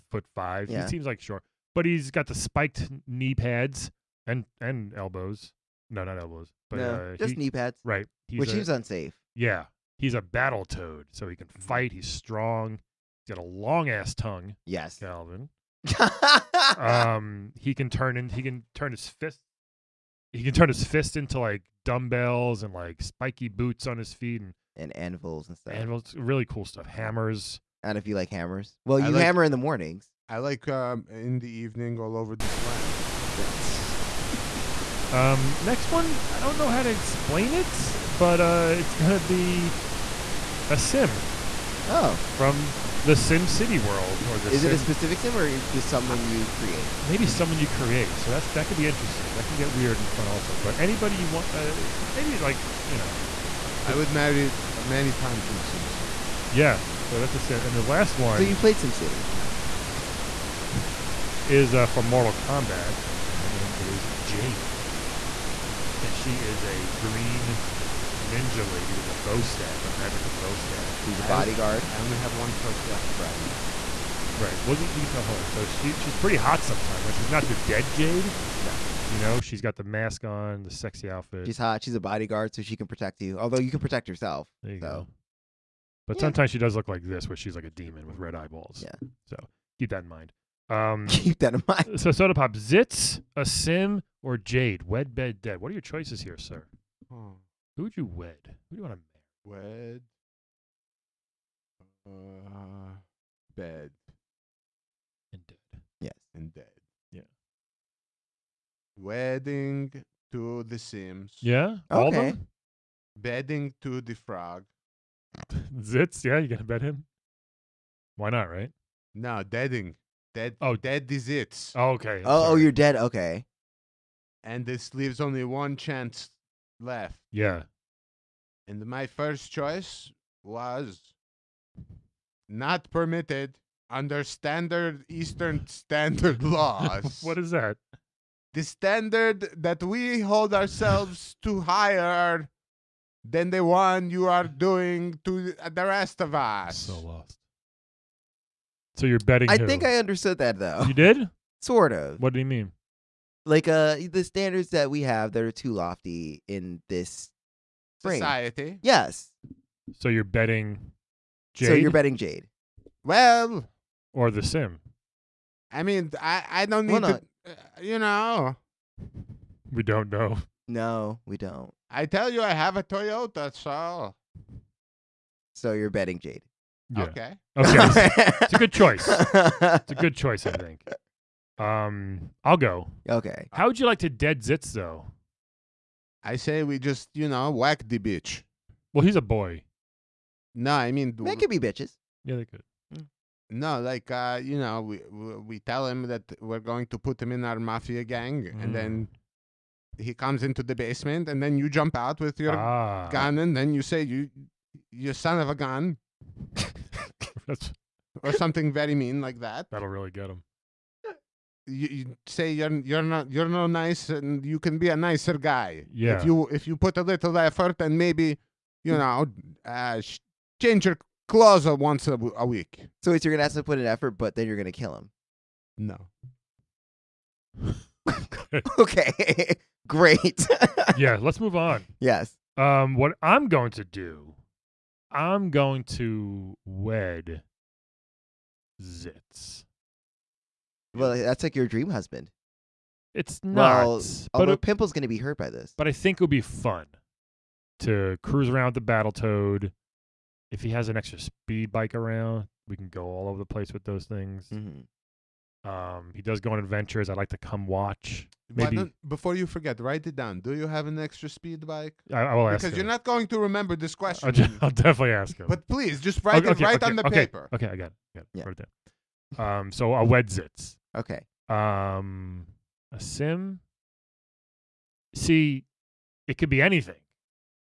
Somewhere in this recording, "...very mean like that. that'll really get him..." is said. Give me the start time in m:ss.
3:28.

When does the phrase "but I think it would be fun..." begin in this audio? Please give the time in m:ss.
4:05.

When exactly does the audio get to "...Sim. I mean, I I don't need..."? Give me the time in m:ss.
2:44.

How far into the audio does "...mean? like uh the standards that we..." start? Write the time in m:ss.
2:32.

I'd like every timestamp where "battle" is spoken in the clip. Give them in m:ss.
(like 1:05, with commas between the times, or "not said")
0:10, 4:08.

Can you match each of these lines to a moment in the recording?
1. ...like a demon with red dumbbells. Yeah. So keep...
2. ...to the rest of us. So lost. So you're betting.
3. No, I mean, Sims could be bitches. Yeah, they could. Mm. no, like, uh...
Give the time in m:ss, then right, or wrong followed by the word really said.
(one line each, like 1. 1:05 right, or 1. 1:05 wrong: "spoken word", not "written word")
1. 1:27 wrong: "eyeballs", not "dumbbells"
2. 2:25 right
3. 3:10 wrong: "They", not "Sims".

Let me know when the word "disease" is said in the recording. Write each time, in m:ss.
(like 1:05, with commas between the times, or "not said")
not said.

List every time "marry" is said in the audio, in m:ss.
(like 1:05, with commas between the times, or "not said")
0:54, 1:39.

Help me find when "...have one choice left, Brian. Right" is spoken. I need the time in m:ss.
1:12.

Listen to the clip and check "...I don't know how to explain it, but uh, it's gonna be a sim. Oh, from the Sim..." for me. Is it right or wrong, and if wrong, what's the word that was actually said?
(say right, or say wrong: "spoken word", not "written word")
right.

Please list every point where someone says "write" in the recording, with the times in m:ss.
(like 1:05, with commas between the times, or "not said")
4:19, 4:26.